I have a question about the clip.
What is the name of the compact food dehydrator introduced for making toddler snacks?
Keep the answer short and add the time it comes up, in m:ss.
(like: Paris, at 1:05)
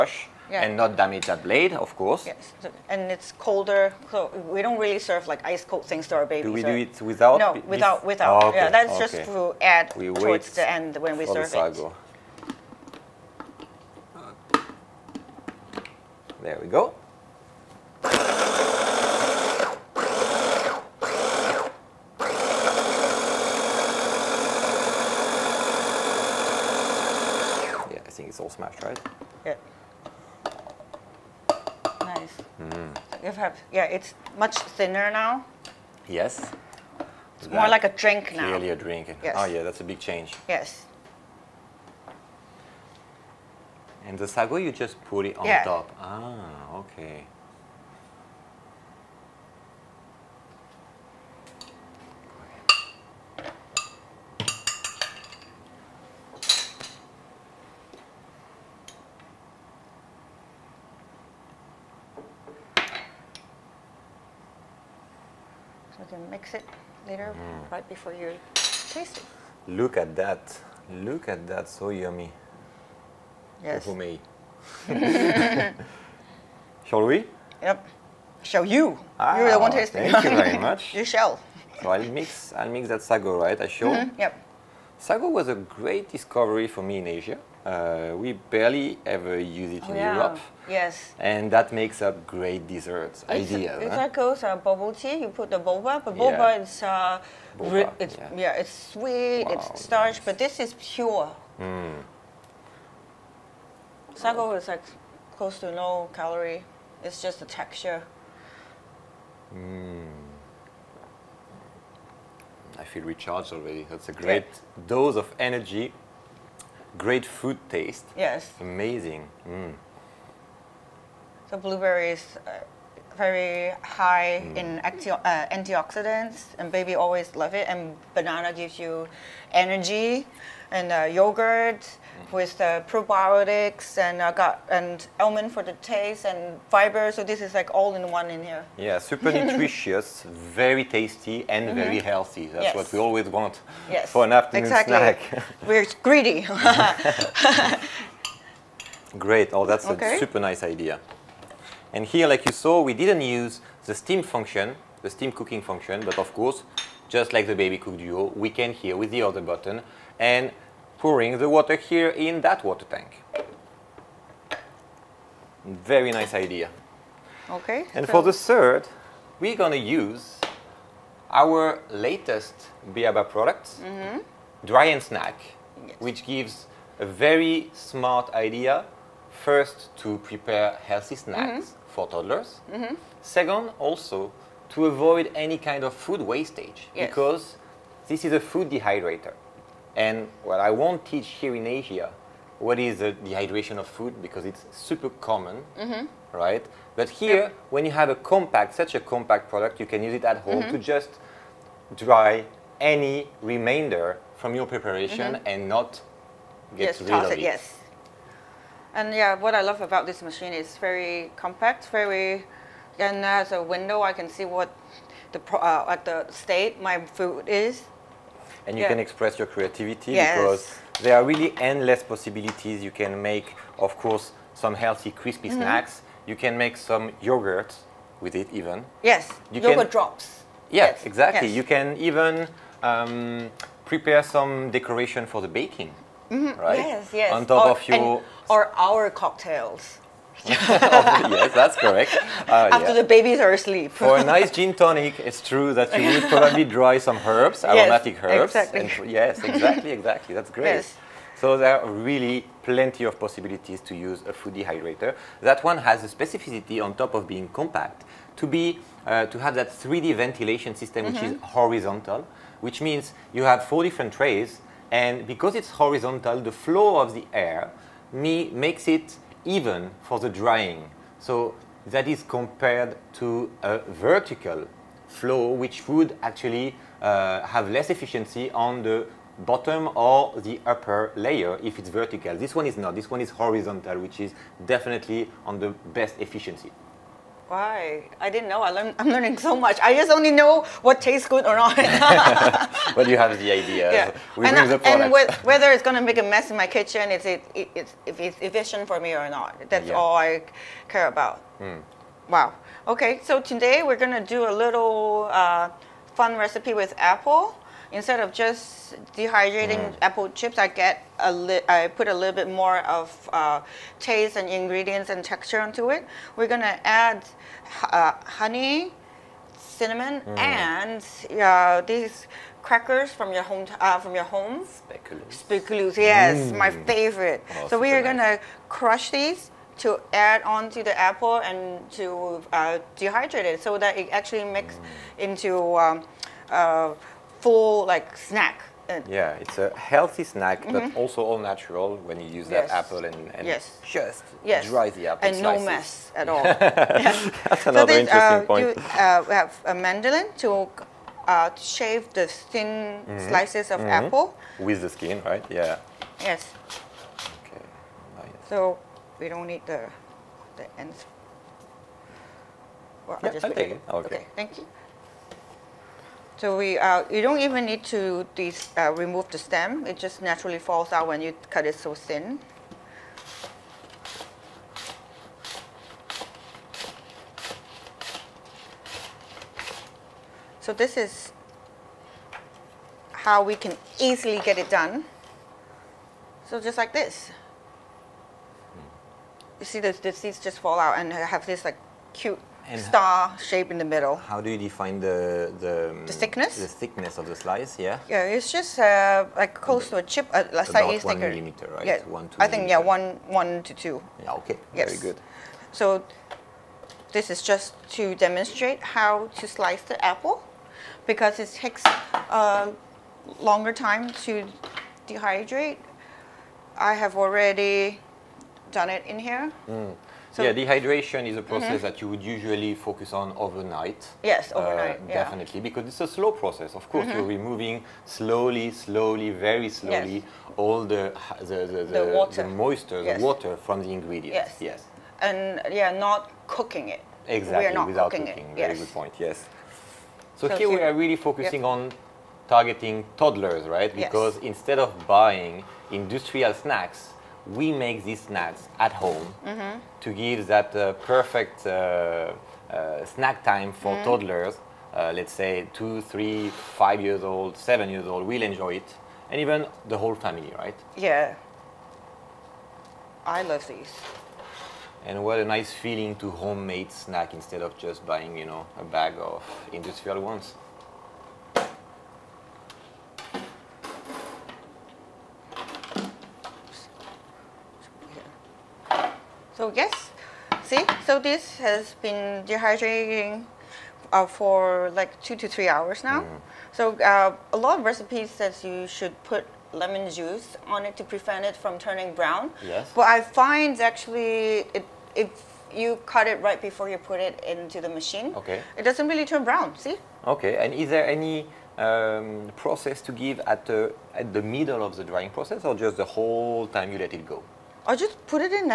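Dry and Snack, at 2:54.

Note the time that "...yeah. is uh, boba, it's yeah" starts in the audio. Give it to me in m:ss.
1:36.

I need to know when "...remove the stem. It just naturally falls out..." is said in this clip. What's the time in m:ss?
6:08.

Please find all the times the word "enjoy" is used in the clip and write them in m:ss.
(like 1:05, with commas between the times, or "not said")
7:38.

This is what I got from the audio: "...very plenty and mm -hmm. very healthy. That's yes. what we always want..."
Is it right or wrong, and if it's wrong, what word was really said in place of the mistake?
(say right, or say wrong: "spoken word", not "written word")
wrong: "tasty", not "plenty".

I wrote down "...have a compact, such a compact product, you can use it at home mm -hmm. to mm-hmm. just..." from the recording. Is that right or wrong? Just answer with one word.
right.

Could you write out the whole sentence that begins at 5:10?
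apple chips, I get a li I put a little bit more of uh, taste and ingredients and texture onto it.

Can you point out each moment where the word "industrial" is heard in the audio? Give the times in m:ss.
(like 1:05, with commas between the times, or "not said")
7:25, 7:49.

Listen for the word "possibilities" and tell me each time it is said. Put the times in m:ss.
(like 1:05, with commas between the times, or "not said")
3:42, 4:13.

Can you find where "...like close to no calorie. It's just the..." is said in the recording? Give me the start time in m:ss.
1:44.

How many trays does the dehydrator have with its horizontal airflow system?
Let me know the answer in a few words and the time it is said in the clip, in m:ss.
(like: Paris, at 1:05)
4, at 4:23.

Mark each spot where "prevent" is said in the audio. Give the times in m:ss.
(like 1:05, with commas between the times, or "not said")
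8:11.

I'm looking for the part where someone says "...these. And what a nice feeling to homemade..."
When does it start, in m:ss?
7:43.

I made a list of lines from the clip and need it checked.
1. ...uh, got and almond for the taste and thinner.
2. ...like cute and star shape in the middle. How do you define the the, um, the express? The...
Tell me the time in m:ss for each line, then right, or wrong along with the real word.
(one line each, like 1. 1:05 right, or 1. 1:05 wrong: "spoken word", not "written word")
1. 2:14 wrong: "fiber", not "thinner"
2. 6:31 wrong: "thickness", not "express".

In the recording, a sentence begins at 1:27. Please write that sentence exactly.
Uh, we barely ever use it in yeah.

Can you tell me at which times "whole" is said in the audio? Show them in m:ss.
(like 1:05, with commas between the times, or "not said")
7:39, 8:26.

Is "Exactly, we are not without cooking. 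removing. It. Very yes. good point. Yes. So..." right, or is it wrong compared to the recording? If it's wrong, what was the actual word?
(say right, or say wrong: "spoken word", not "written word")
wrong: "cooking", not "removing".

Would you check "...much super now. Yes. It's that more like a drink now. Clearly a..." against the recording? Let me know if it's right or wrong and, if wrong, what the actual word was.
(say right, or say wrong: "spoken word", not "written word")
wrong: "thinner", not "super".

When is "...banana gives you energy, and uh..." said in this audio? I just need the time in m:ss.
2:08.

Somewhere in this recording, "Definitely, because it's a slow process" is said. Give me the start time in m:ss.
7:05.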